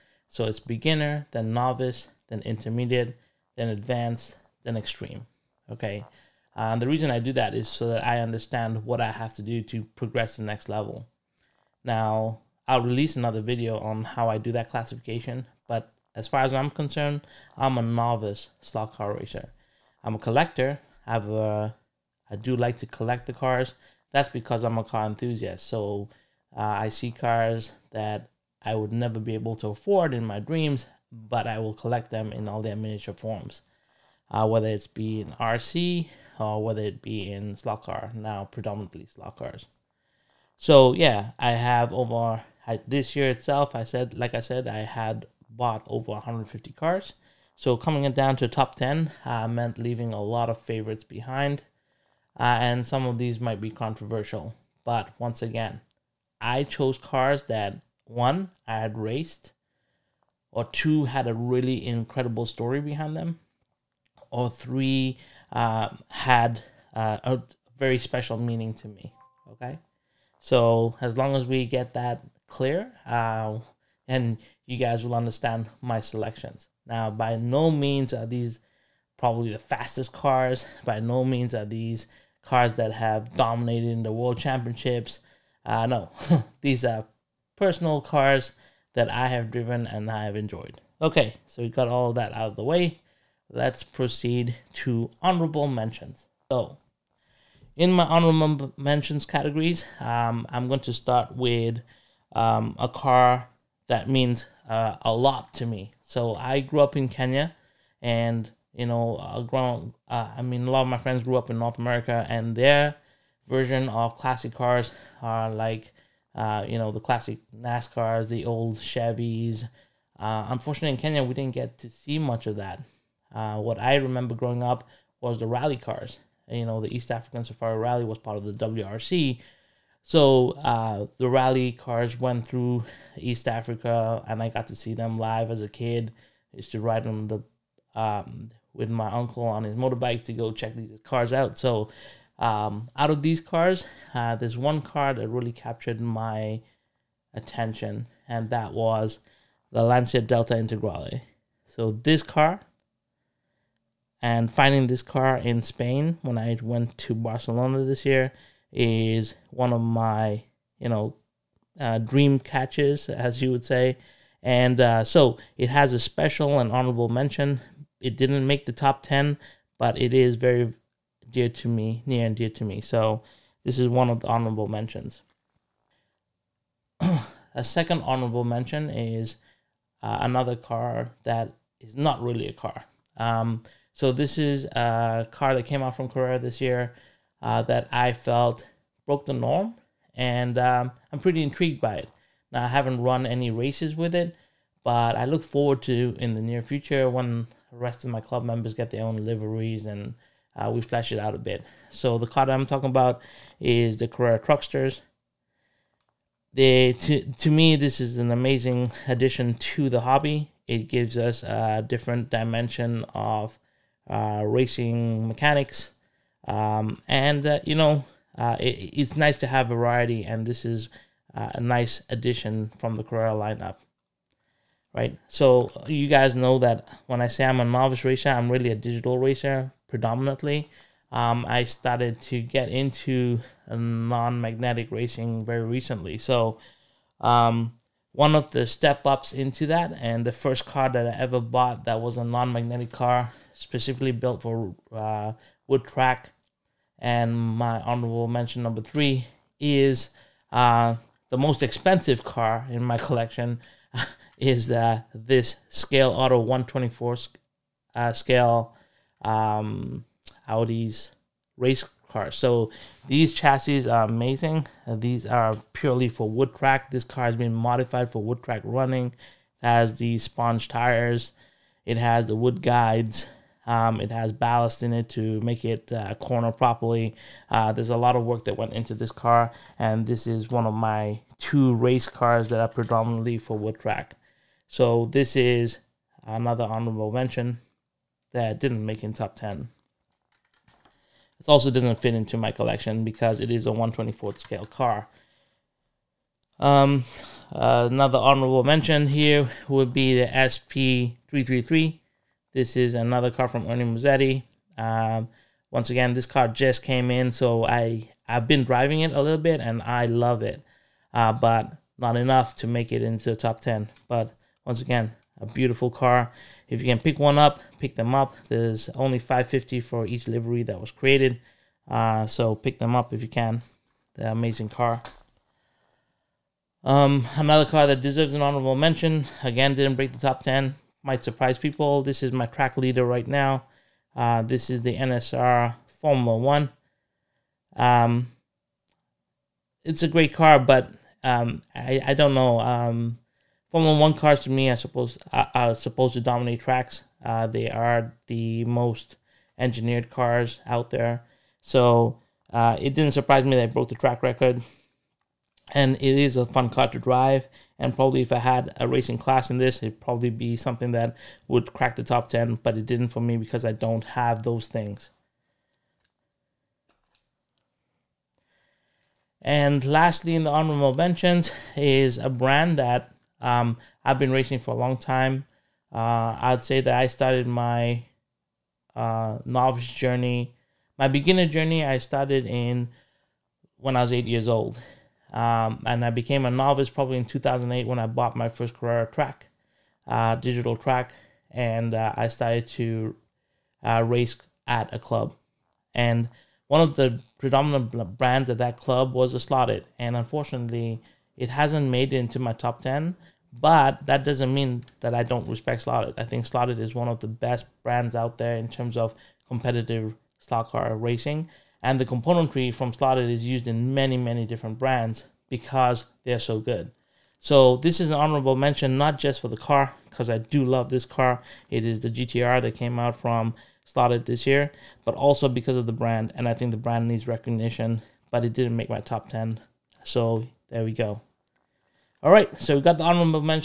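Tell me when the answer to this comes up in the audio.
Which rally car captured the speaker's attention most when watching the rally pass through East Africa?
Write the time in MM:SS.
02:29.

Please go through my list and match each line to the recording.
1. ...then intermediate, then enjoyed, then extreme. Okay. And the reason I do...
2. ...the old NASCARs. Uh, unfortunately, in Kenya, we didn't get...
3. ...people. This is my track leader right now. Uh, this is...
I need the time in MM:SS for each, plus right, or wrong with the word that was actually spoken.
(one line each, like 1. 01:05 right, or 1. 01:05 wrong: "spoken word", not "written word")
1. 00:02 wrong: "advanced", not "enjoyed"
2. 01:58 wrong: "Chevys", not "NASCARs"
3. 05:31 right.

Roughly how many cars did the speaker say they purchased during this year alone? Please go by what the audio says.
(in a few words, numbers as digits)
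150.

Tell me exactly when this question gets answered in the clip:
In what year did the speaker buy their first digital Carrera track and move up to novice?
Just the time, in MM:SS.
06:27.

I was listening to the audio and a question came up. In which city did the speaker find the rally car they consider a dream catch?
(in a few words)
Barcelona.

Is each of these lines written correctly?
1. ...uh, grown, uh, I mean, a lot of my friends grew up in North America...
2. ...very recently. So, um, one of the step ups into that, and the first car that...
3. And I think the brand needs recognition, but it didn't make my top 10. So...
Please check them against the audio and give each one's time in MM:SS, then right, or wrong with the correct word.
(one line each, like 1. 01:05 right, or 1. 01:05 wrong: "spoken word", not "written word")
1. 01:49 right
2. 03:55 right
3. 07:06 right.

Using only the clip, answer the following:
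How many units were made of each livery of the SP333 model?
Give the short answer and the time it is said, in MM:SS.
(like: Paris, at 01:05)
550, at 05:19.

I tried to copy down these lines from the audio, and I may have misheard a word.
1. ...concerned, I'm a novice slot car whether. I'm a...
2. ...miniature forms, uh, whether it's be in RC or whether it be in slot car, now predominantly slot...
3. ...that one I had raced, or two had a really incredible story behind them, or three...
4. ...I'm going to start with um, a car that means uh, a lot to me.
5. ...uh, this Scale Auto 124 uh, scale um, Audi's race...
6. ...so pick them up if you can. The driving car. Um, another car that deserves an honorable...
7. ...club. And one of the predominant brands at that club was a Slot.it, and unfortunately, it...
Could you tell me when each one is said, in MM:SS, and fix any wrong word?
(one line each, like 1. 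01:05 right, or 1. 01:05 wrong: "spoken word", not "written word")
1. 00:16 wrong: "racer", not "whether"
2. 00:32 right
3. 00:57 right
4. 01:40 right
5. 04:14 right
6. 05:22 wrong: "amazing", not "driving"
7. 06:34 right.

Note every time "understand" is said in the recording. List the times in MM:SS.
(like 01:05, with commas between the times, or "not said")
00:08, 01:15.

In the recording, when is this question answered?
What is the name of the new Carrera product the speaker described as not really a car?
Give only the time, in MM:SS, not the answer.
03:24.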